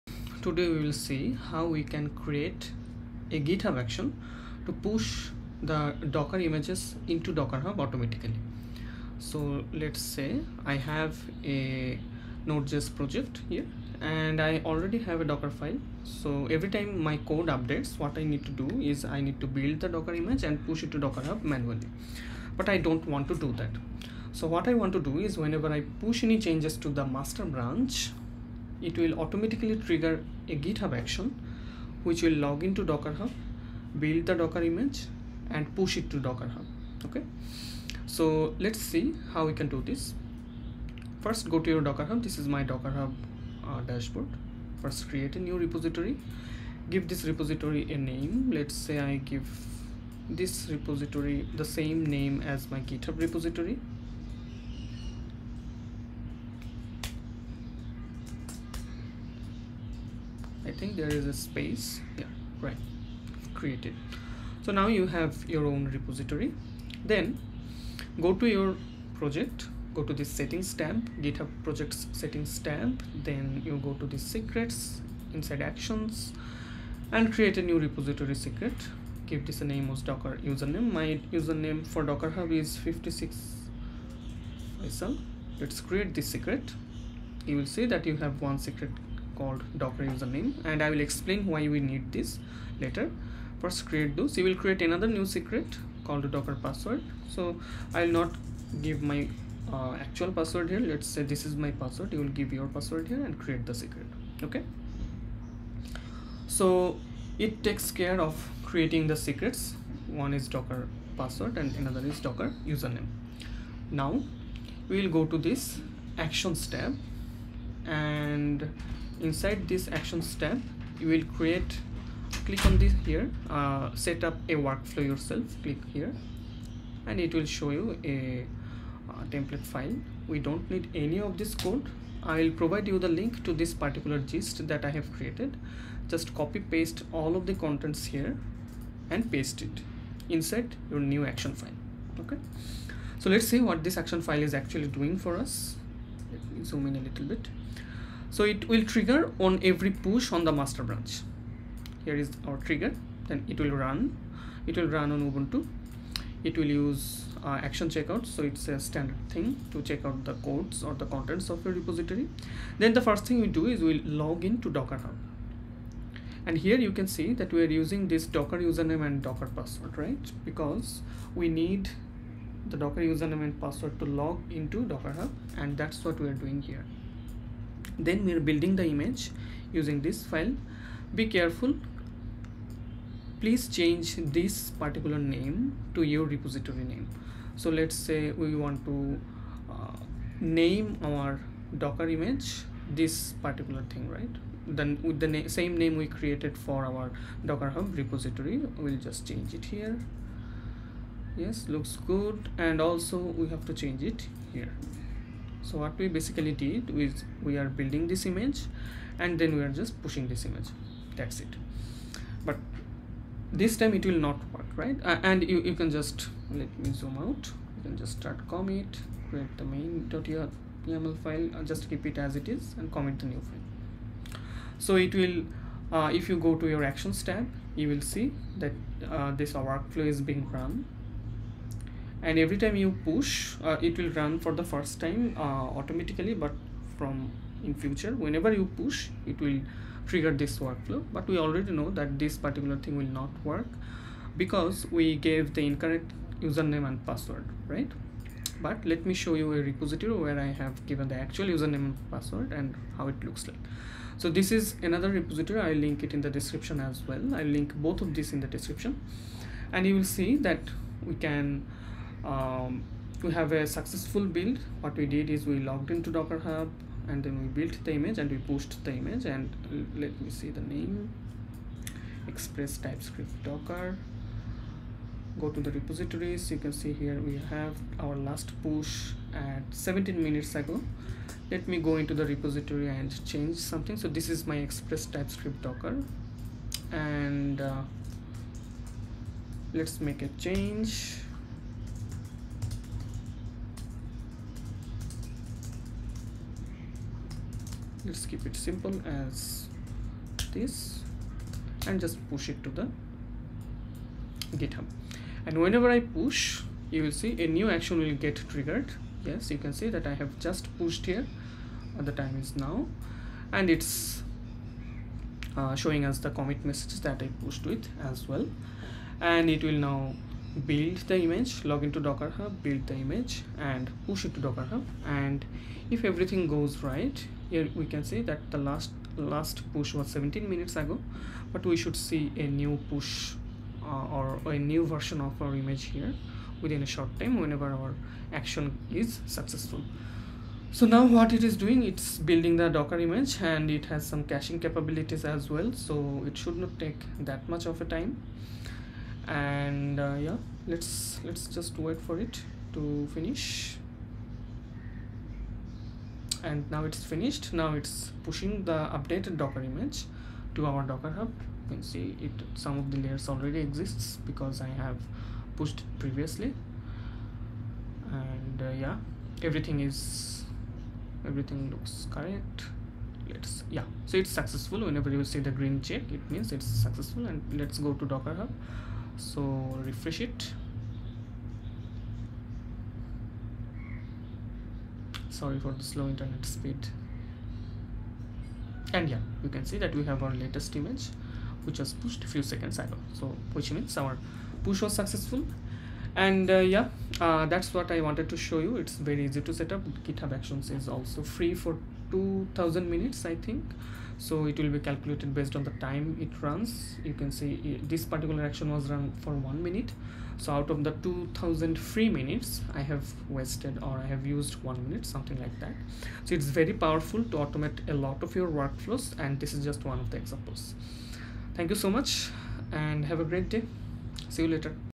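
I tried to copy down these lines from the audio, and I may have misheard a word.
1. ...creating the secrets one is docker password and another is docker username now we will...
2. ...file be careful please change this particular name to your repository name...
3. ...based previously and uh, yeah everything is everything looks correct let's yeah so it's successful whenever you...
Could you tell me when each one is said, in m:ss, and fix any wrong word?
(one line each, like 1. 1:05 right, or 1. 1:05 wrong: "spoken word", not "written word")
1. 1:48 right
2. 3:00 right
3. 6:05 wrong: "pushed", not "based".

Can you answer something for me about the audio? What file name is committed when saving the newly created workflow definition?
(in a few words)
main.yaml.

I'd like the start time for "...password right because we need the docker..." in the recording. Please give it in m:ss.
2:49.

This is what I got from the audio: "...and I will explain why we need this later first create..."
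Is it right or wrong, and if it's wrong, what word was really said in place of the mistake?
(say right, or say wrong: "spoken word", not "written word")
right.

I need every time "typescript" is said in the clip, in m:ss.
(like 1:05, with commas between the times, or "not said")
4:32, 4:45.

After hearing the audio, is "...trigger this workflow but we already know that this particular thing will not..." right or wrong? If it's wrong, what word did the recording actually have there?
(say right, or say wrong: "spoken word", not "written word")
right.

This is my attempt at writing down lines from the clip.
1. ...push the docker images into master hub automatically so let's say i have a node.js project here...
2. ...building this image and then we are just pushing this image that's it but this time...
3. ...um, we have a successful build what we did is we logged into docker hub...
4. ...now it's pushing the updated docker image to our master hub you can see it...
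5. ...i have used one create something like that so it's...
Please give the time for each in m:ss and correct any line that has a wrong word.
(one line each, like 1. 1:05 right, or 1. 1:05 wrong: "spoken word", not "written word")
1. 0:04 wrong: "docker", not "master"
2. 3:27 right
3. 4:22 right
4. 5:57 wrong: "docker", not "master"
5. 6:54 wrong: "minute", not "create".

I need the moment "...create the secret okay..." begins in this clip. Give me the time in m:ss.
1:43.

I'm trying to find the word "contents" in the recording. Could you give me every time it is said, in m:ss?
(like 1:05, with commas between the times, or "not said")
2:17, 2:41.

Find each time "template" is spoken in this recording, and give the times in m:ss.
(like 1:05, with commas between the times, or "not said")
2:09.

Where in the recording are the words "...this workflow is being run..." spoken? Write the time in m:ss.
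3:49.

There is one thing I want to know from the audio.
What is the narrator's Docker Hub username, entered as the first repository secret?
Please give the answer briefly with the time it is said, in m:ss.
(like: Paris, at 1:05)
56 faisal, at 1:22.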